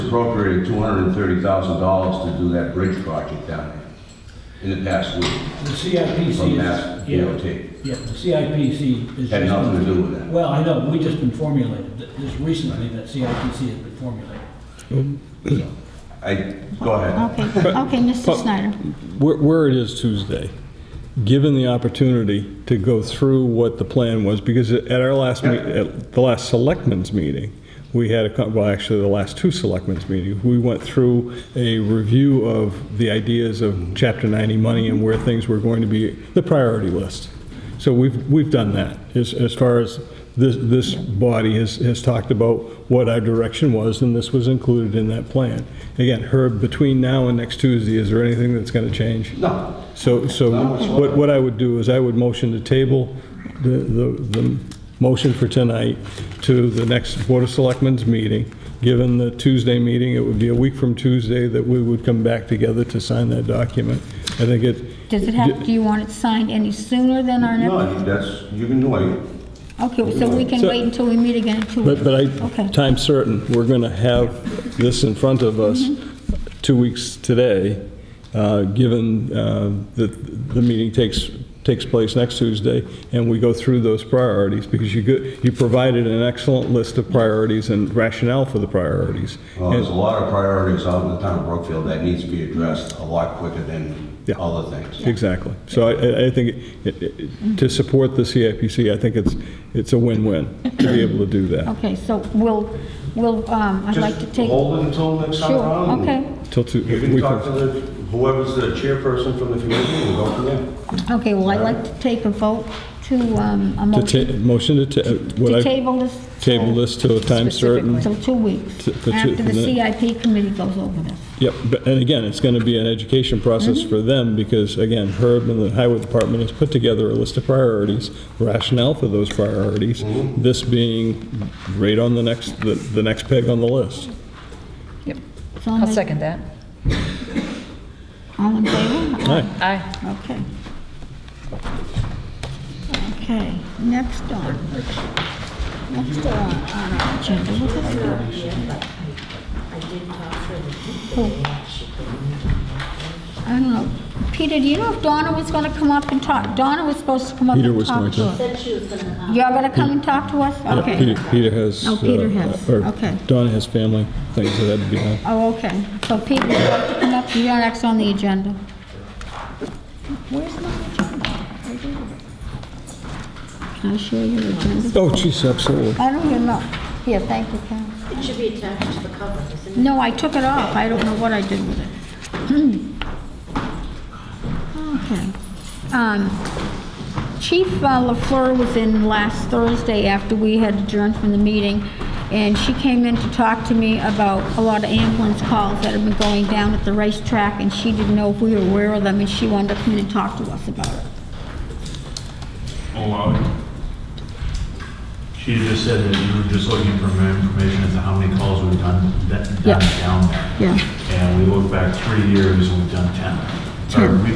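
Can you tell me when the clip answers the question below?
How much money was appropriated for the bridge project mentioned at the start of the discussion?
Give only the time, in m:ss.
0:00.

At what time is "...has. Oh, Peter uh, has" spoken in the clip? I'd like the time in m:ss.
2:41.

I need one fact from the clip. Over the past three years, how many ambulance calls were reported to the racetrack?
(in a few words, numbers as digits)
10.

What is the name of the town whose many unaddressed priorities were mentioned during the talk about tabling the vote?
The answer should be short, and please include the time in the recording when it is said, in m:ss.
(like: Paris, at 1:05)
Brookfield, at 1:31.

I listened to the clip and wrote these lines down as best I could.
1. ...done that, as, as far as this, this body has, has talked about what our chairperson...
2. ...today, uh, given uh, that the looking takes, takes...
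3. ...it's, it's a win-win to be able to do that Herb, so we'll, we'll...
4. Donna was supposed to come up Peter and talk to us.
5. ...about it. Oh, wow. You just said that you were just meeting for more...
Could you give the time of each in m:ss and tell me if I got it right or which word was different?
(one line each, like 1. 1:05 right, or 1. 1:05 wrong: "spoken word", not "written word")
1. 0:38 wrong: "direction", not "chairperson"
2. 1:17 wrong: "meeting", not "looking"
3. 1:39 wrong: "Okay", not "Herb"
4. 2:36 right
5. 3:20 wrong: "looking", not "meeting".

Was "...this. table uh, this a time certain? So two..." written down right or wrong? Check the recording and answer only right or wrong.
right.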